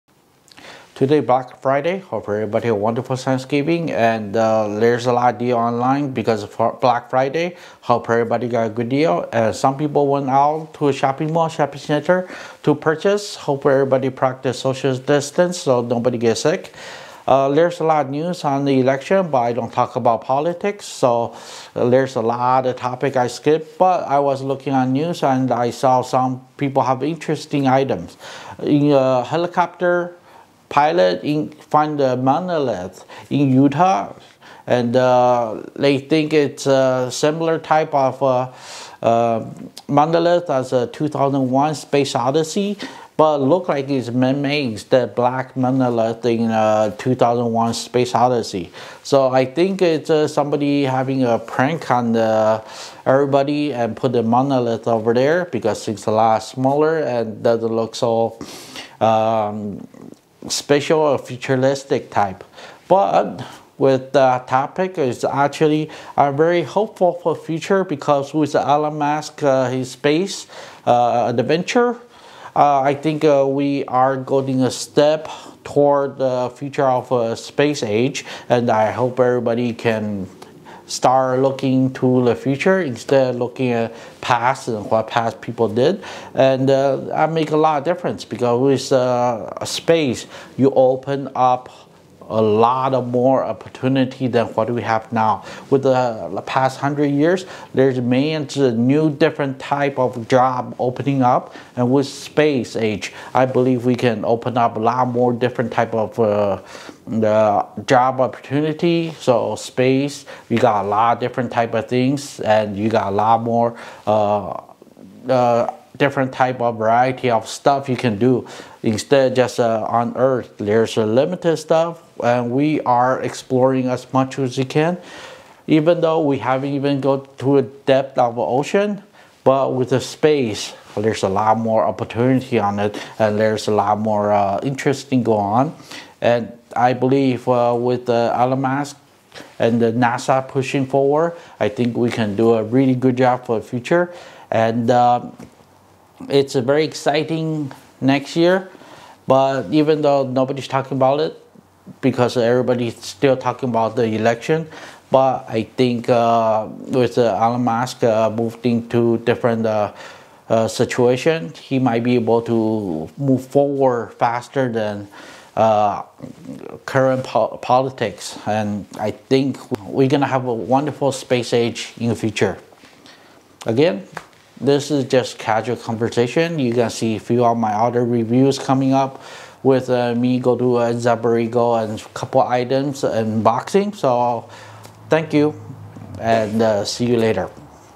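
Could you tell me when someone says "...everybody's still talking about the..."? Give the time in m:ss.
2:32.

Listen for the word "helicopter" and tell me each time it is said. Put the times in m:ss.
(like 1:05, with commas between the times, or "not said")
0:29.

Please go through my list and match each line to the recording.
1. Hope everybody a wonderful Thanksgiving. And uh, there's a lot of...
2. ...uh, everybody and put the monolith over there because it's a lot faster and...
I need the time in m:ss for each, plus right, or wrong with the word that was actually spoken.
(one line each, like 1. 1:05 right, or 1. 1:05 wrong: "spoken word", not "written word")
1. 0:01 right
2. 0:52 wrong: "smaller", not "faster".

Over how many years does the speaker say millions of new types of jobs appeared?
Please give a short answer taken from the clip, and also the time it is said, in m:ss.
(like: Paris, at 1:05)
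100, at 1:36.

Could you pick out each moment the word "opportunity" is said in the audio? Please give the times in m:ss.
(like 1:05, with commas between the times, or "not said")
1:33, 1:48, 2:11.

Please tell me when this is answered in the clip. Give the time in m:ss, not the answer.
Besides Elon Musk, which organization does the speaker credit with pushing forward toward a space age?
2:19.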